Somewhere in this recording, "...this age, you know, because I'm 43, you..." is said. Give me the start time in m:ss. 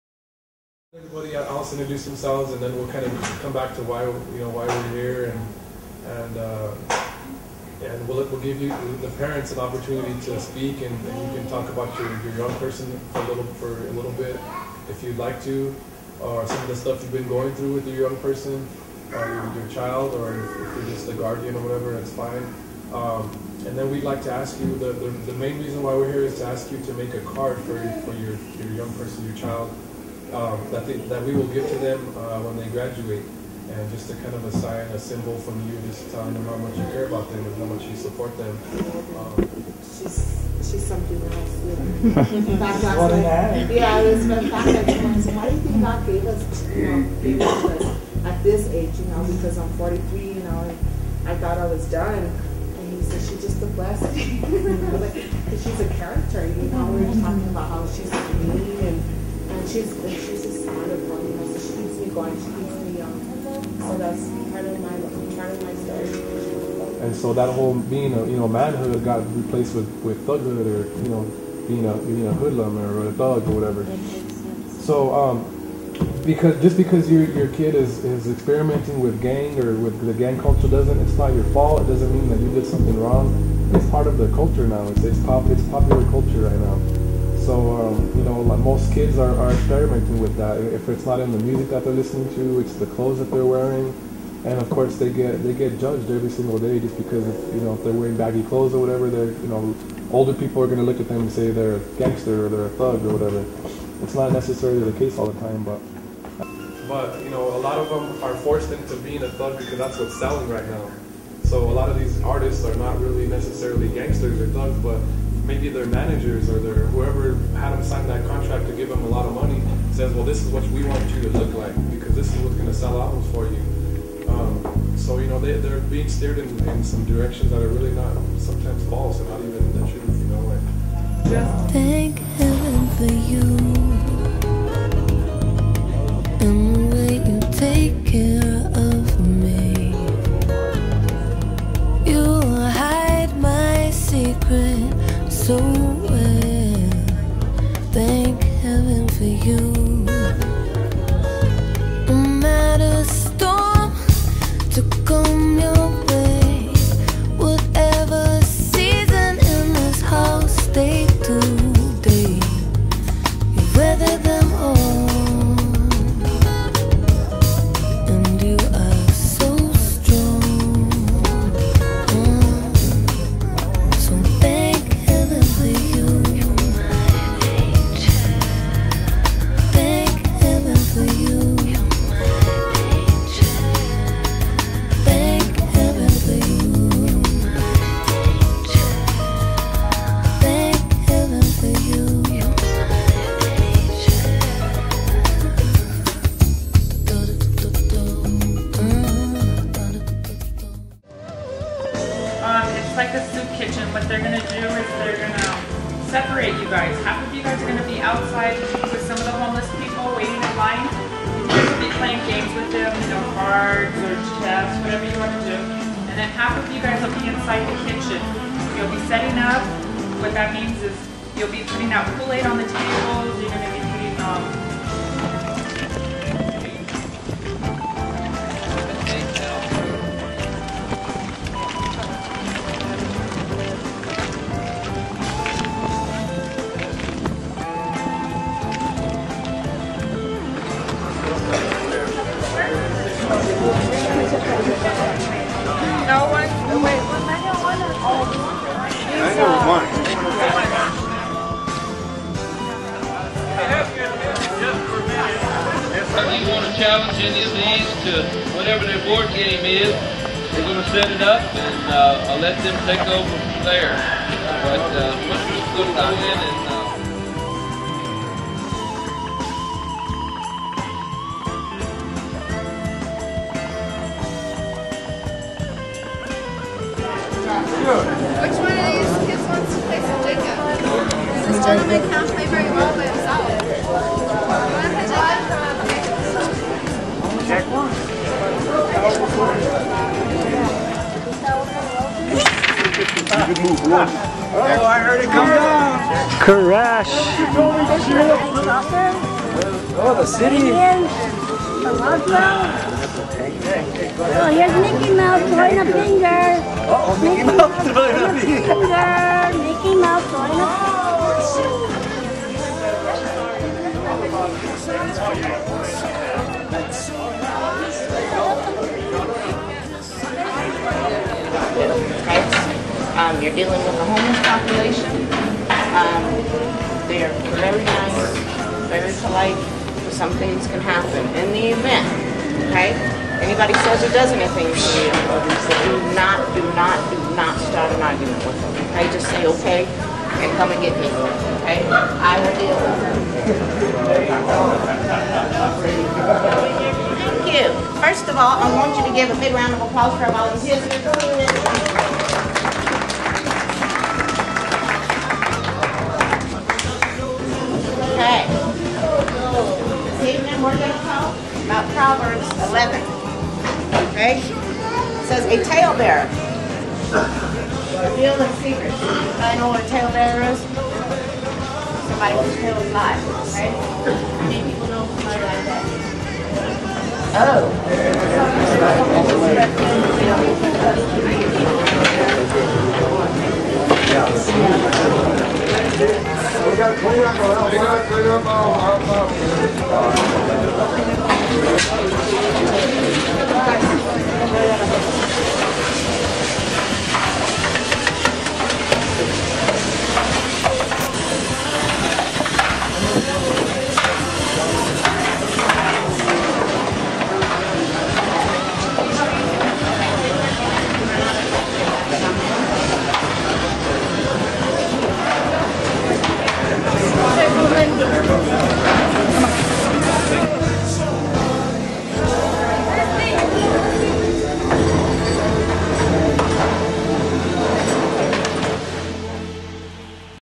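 0:48.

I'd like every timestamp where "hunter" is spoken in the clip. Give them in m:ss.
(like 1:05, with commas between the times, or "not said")
not said.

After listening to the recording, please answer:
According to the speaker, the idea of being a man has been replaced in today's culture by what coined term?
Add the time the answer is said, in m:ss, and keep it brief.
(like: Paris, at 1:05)
Thughood, at 1:10.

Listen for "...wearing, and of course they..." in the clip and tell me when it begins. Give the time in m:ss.
1:33.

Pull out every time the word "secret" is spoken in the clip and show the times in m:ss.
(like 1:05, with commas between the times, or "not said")
6:08.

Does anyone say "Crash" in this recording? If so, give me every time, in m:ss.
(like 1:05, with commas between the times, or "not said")
4:56.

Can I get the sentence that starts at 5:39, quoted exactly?
Just say, okay, and come and get me, okay?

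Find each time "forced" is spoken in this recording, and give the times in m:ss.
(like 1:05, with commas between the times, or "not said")
1:48.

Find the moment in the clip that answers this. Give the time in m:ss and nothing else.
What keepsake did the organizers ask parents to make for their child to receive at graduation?
0:27.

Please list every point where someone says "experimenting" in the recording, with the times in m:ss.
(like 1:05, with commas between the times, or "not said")
1:18, 1:29.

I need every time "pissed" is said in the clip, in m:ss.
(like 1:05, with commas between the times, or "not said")
not said.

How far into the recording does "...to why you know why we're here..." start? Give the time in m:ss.
0:03.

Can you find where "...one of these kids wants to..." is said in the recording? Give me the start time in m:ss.
4:38.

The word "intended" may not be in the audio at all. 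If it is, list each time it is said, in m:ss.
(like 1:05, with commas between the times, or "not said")
not said.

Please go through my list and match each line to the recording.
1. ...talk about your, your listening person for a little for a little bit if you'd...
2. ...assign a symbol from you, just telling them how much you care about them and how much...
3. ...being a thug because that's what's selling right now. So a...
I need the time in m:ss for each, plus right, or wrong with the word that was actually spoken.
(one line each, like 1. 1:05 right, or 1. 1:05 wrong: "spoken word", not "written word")
1. 0:11 wrong: "young", not "listening"
2. 0:34 right
3. 1:48 right.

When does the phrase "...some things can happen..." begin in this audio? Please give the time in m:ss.
5:30.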